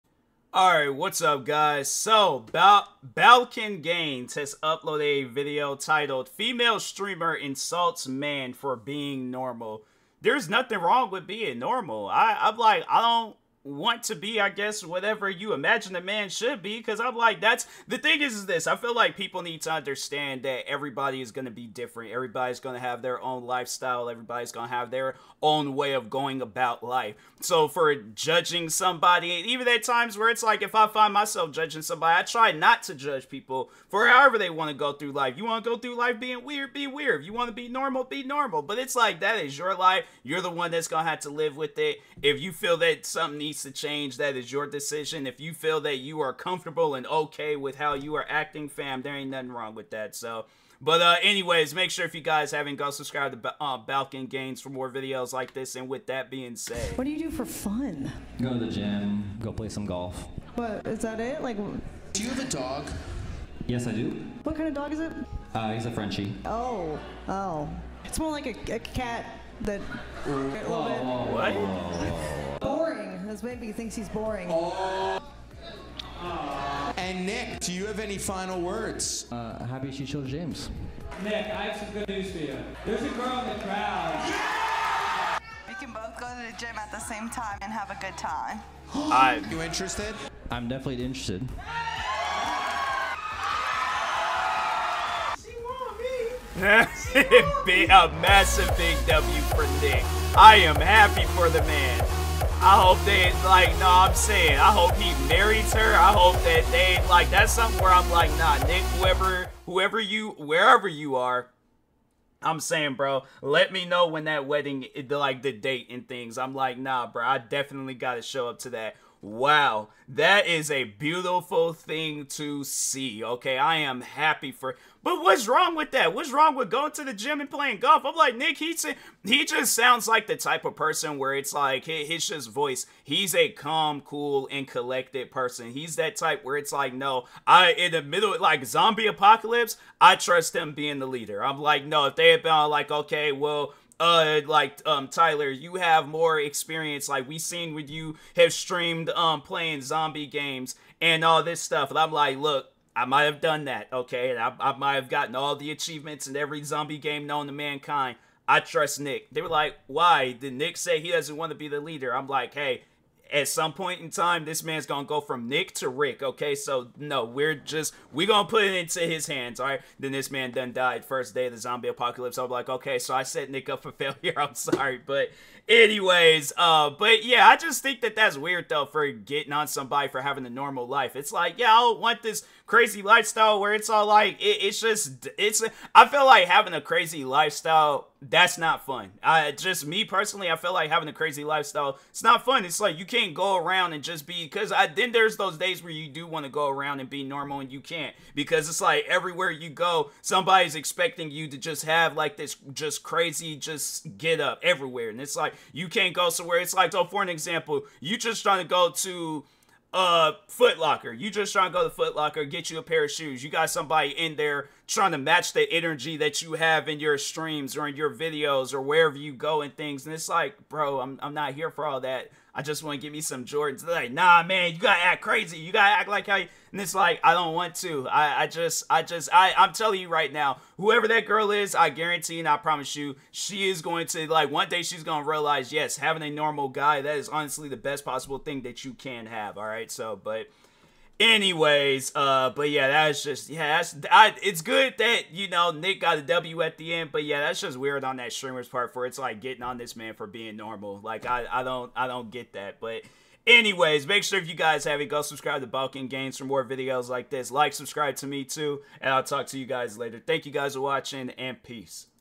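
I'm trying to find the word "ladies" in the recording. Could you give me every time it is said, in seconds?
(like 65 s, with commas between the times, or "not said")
not said.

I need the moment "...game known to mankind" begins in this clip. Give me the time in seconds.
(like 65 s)
156 s.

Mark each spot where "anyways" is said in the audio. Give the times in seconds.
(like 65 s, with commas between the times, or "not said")
51 s, 175 s, 241 s, 253 s.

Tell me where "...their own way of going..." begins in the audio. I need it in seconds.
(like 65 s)
24 s.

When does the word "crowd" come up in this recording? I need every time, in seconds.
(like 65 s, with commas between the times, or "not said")
83 s.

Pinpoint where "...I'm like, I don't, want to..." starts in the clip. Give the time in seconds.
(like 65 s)
12 s.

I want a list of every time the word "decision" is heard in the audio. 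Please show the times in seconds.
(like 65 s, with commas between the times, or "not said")
44 s.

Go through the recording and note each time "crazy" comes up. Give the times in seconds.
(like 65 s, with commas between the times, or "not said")
182 s, 186 s, 191 s, 203 s, 225 s.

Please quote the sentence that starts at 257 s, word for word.
Like, subscribe to me too, and I'll talk to you guys later.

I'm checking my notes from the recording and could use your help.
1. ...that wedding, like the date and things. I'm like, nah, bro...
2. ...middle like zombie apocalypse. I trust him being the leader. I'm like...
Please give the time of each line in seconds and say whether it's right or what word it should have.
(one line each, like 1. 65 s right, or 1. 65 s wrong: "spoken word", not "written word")
1. 114 s right
2. 138 s right.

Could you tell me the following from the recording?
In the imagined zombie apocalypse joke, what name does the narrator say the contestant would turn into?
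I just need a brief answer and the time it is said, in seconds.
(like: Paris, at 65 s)
Rick, at 165 s.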